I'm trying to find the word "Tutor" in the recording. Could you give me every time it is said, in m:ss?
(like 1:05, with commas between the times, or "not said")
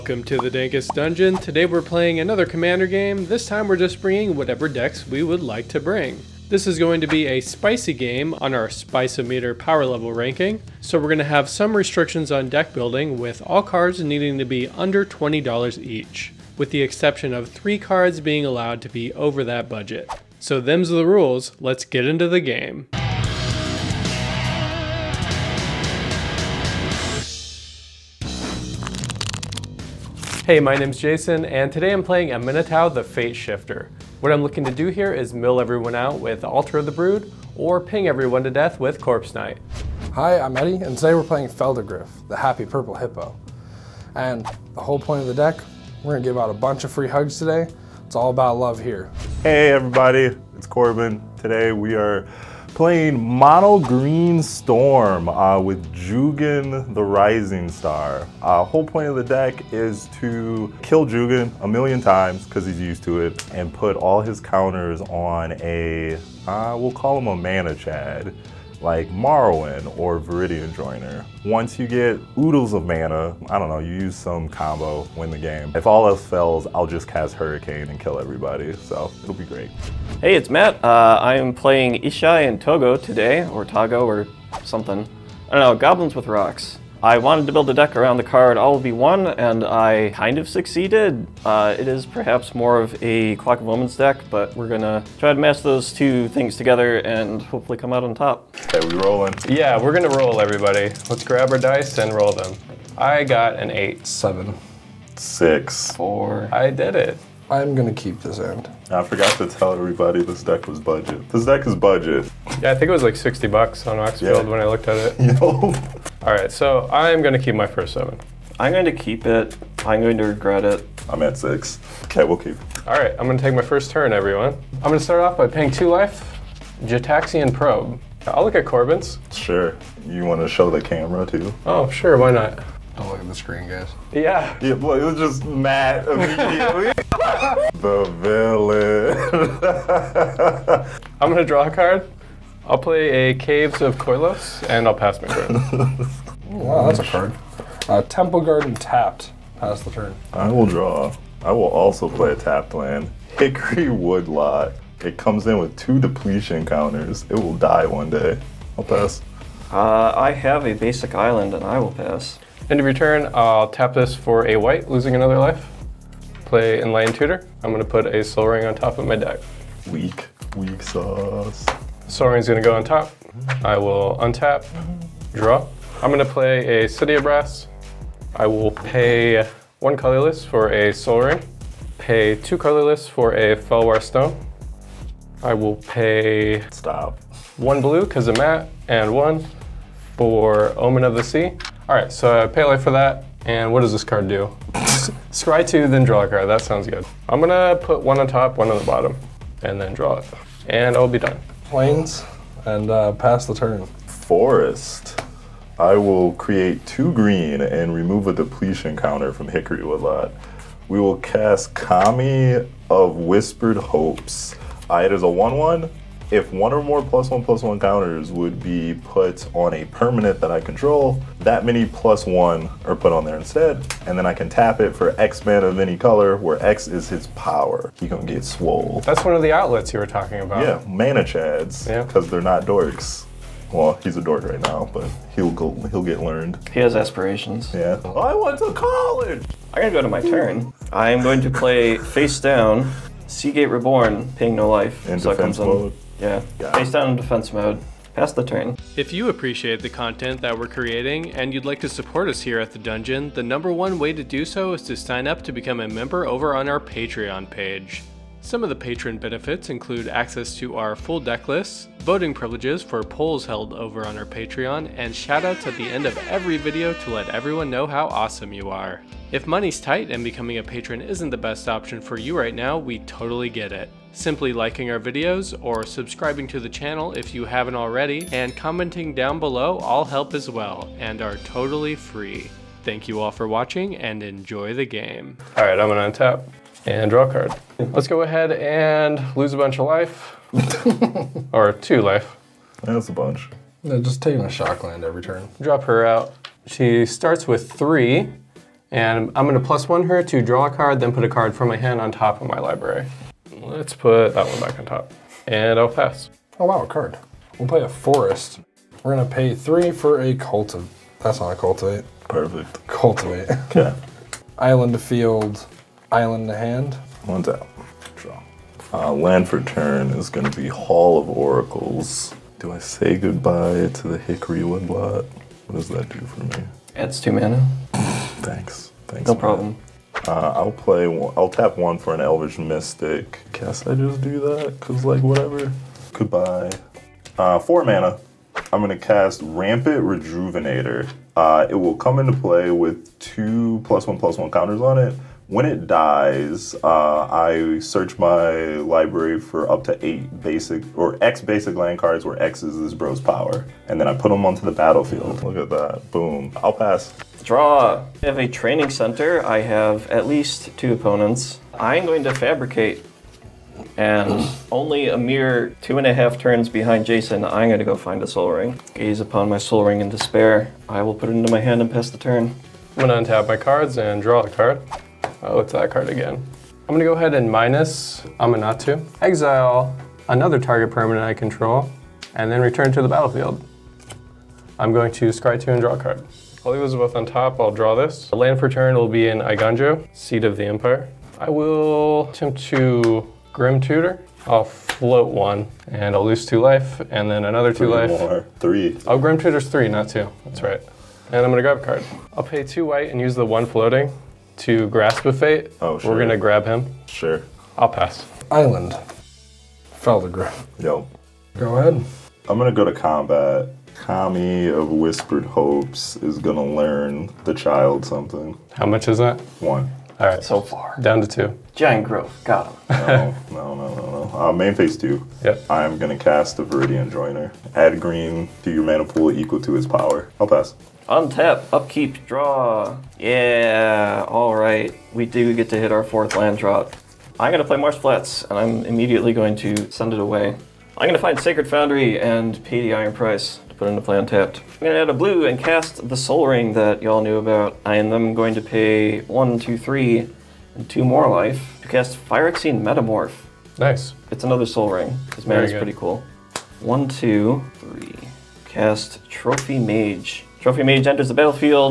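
2:47, 6:33, 6:39.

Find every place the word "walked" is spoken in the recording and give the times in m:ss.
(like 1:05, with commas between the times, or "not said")
not said.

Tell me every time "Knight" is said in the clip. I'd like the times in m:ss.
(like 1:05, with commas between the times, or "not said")
0:39.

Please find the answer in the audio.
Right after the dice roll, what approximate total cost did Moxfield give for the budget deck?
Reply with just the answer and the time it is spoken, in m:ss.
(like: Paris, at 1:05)
$60, at 1:53.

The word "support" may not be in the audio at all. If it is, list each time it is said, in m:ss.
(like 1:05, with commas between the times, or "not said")
4:11.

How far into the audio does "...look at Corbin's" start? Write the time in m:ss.
2:08.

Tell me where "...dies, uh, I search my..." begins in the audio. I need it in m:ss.
5:45.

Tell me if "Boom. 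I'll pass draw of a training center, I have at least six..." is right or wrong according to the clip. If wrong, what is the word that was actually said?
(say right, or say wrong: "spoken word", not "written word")
wrong: "two", not "six".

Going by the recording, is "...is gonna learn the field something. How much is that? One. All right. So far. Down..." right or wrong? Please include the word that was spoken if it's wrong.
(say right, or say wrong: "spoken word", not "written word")
wrong: "child", not "field".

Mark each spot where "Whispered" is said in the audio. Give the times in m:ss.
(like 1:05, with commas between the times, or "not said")
3:33, 6:54.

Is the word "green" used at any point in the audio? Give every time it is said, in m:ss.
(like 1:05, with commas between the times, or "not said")
0:53, 3:27, 7:07.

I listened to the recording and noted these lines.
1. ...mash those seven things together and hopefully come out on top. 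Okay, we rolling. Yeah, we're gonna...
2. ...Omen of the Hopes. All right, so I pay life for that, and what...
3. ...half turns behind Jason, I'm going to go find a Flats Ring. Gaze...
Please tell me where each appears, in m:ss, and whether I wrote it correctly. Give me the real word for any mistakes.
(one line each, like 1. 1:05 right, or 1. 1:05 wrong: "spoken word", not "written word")
1. 1:35 wrong: "two", not "seven"
2. 3:10 wrong: "Sea", not "Hopes"
3. 6:06 wrong: "Sol", not "Flats".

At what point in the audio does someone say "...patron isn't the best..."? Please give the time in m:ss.
4:30.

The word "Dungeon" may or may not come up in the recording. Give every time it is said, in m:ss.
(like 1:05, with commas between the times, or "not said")
0:00, 4:12.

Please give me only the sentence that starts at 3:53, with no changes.
Well, he's a dork right now, but he'll go, he'll get learned.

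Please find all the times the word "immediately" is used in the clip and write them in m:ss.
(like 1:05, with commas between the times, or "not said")
2:16, 7:18.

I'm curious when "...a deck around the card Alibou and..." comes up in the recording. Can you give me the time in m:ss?
1:27.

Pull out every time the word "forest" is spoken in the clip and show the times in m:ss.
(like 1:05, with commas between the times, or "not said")
3:23, 5:07.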